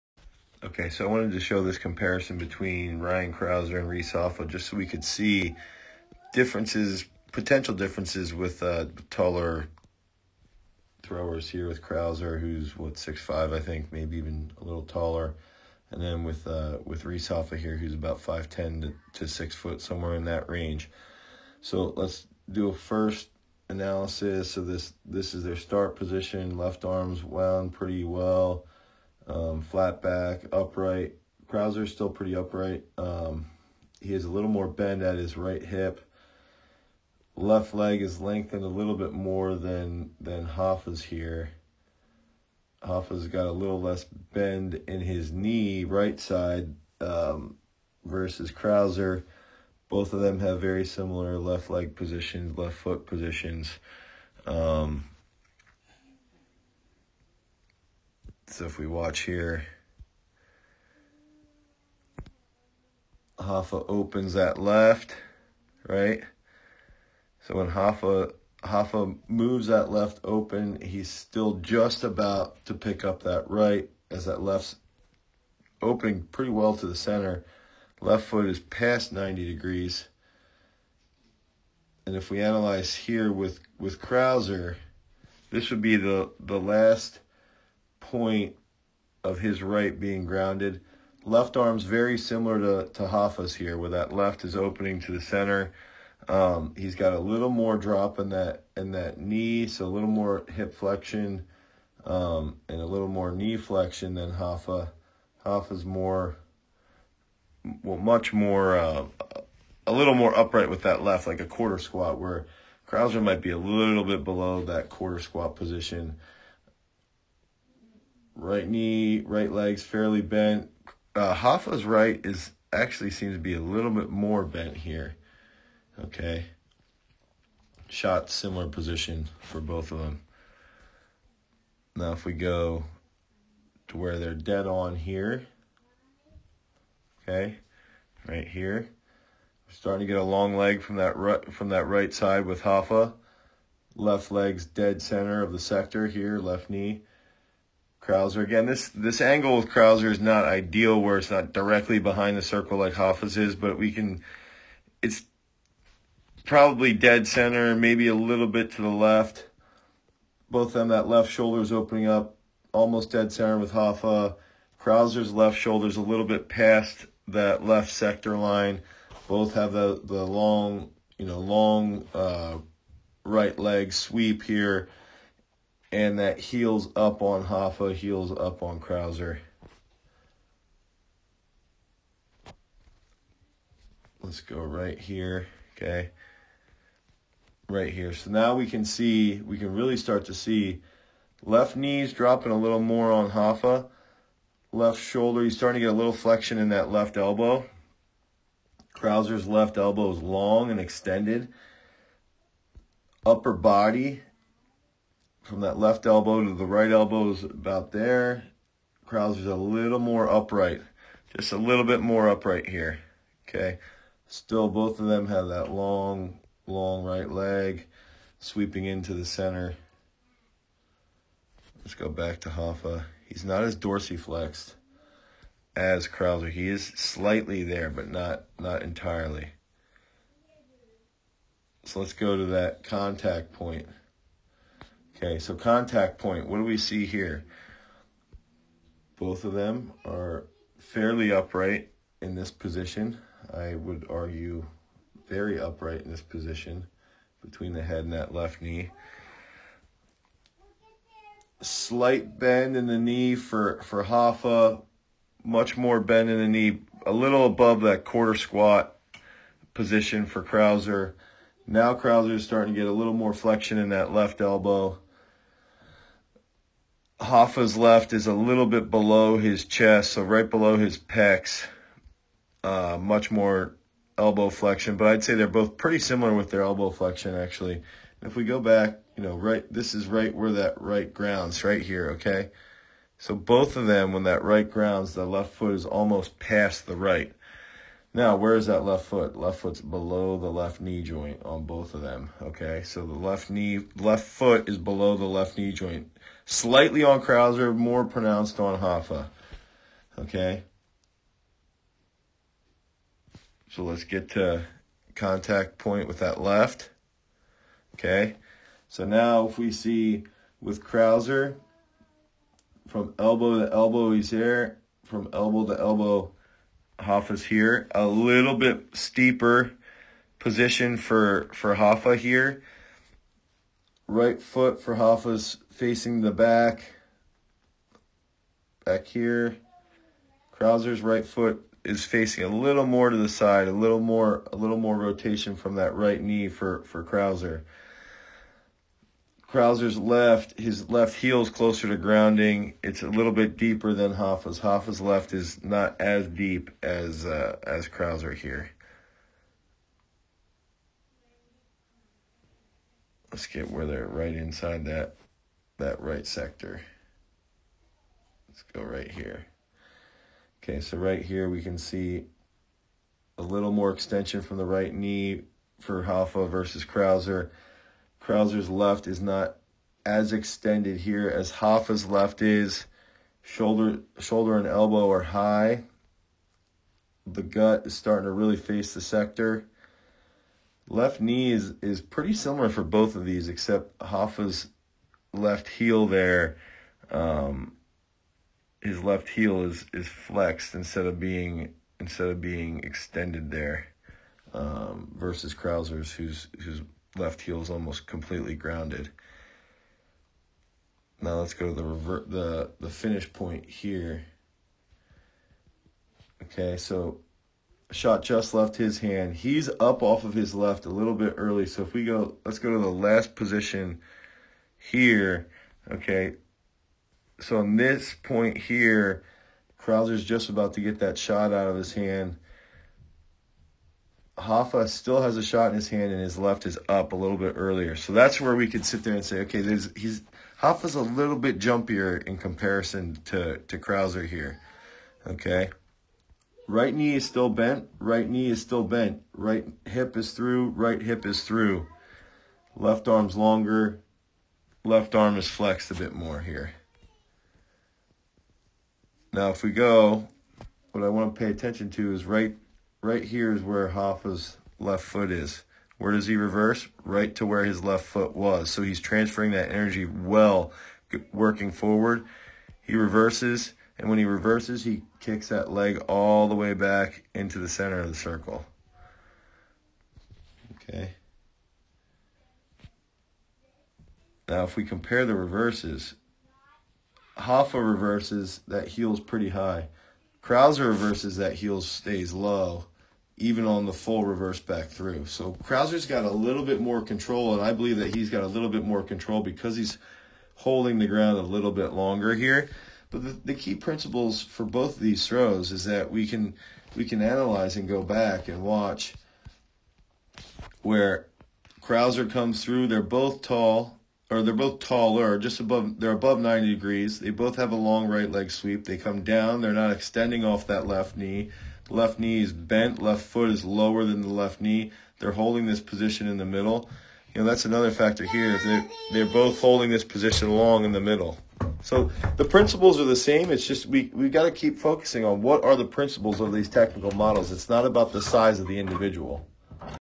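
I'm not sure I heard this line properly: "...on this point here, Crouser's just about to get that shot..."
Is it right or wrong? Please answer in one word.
right.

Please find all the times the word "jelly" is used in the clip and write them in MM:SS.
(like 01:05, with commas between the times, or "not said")
not said.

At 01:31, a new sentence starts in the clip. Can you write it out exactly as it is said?
Left arm's very similar to, to Hoffa's here, where that left is opening to the center.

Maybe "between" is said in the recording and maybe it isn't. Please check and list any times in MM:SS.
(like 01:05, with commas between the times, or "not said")
00:02, 04:07.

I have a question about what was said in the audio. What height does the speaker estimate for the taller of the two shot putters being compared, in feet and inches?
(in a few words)
6'5".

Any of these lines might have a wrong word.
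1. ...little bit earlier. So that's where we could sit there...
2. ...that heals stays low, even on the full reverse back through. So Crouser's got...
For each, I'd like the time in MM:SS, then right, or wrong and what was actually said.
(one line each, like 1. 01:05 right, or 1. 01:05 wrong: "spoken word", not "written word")
1. 07:07 right
2. 08:01 wrong: "heels", not "heals".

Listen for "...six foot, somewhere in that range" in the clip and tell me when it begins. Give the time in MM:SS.
00:19.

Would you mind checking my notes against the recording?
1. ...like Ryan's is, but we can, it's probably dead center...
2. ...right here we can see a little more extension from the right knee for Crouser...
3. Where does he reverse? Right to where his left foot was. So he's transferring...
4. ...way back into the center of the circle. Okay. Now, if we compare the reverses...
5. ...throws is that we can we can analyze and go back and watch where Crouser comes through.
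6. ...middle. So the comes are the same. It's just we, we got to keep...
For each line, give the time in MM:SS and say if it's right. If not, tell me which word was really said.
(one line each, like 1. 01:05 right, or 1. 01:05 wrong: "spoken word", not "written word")
1. 02:32 wrong: "Hoffa", not "Ryan"
2. 06:00 wrong: "Hoffa", not "Crouser"
3. 07:35 right
4. 07:46 right
5. 08:15 right
6. 08:41 wrong: "principles", not "comes".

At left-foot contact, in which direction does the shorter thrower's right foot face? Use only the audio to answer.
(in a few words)
the back.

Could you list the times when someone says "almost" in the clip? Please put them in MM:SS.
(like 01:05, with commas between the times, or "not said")
02:42, 04:45, 06:37.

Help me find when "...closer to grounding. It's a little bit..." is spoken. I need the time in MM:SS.
05:41.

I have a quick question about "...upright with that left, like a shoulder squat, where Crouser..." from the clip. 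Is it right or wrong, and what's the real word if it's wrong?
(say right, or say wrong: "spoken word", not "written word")
wrong: "quarter", not "shoulder".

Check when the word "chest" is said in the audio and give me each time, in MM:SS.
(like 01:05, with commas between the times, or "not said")
04:29.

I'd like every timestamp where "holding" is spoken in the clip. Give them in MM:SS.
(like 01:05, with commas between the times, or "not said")
08:10, 08:35, 08:39.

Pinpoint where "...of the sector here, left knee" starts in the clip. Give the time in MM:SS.
02:25.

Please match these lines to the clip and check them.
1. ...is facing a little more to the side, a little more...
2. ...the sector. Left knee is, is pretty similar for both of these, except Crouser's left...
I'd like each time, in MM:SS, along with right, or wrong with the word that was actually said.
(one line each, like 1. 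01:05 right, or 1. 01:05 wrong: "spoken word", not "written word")
1. 05:31 right
2. 06:18 wrong: "Hoffa", not "Crouser".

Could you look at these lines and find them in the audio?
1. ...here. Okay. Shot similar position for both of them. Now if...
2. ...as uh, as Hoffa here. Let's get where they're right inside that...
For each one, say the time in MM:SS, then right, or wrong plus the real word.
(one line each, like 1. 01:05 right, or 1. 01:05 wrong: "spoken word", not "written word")
1. 02:04 right
2. 05:46 wrong: "Crouser", not "Hoffa".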